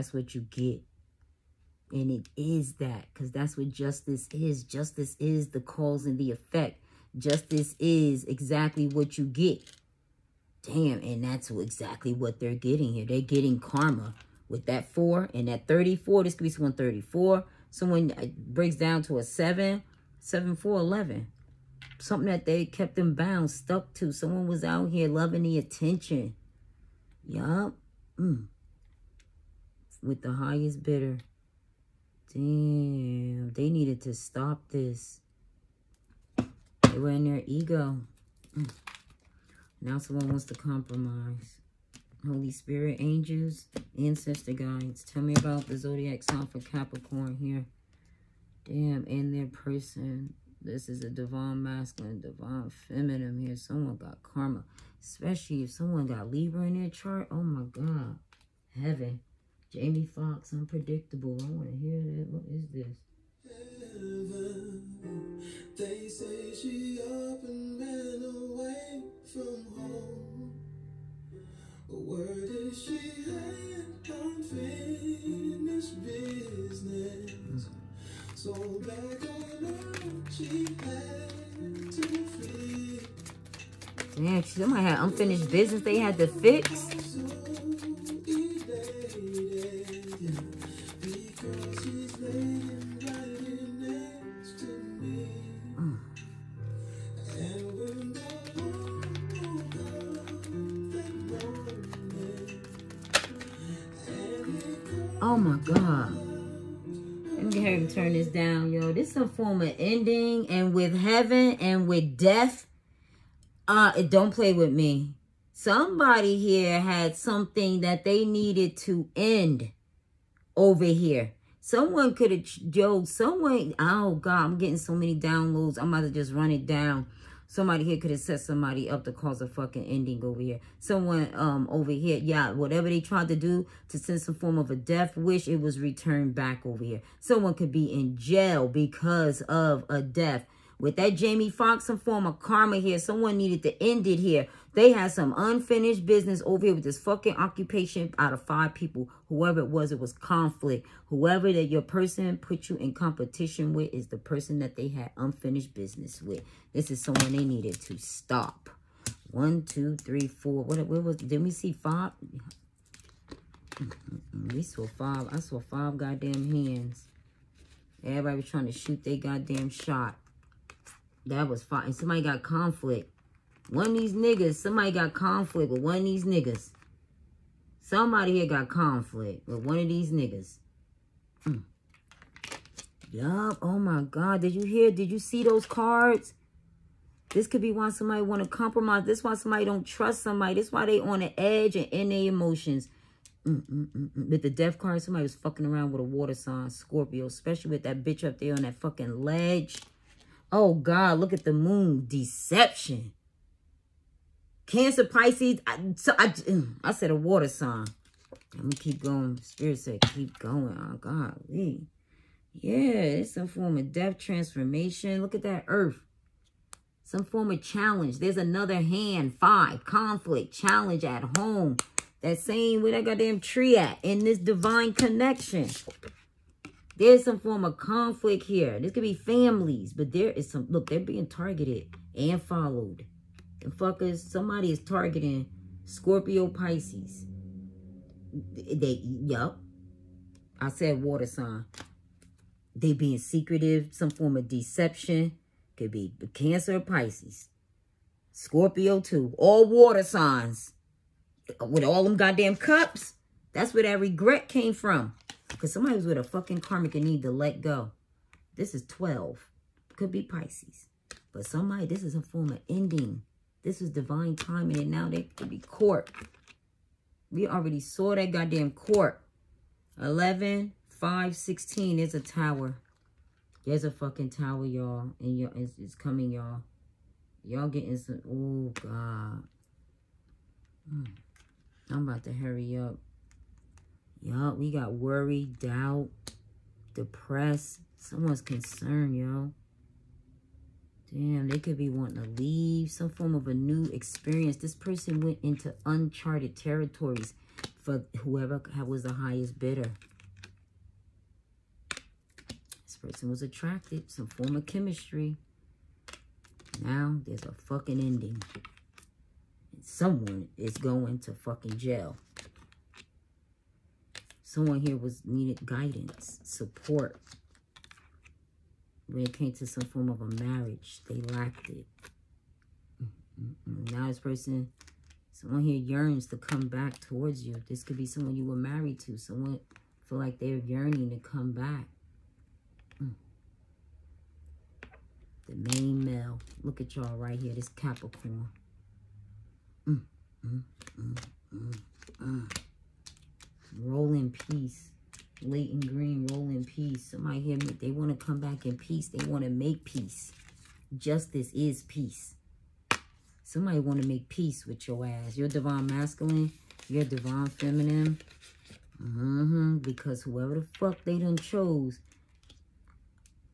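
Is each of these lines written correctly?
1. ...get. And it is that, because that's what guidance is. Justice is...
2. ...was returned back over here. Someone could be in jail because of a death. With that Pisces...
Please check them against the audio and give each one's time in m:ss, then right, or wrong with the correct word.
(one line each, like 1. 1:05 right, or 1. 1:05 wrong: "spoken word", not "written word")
1. 0:00 wrong: "justice", not "guidance"
2. 2:15 wrong: "Jamie", not "Pisces".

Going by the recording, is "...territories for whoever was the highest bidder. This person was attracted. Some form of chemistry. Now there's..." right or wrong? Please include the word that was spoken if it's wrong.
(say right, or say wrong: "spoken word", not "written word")
right.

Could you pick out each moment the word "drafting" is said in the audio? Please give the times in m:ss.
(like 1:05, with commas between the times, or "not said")
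not said.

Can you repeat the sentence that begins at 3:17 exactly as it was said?
Especially with that bitch up there on that fucking ledge.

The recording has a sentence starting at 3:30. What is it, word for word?
Oh God, Yeah, it's some form of death transformation.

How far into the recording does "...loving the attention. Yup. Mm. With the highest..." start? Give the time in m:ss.
0:25.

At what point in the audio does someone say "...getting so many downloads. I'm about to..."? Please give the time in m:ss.
2:04.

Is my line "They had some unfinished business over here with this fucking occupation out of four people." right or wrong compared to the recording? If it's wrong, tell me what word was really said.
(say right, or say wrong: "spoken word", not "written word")
wrong: "five", not "four".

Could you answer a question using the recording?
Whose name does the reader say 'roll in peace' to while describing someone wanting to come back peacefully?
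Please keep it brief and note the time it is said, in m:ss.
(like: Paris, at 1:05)
Layton Greene, at 5:45.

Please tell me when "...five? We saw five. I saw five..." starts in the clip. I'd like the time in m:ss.
2:41.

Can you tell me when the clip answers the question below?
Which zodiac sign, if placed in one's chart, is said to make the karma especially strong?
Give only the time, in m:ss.
0:56.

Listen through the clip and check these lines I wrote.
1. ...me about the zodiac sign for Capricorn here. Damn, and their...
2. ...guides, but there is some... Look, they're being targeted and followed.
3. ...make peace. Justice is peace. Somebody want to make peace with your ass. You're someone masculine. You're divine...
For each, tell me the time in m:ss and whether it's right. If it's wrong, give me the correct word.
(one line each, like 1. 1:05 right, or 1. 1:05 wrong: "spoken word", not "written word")
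1. 0:45 right
2. 3:49 wrong: "families", not "guides"
3. 5:49 wrong: "divine", not "someone".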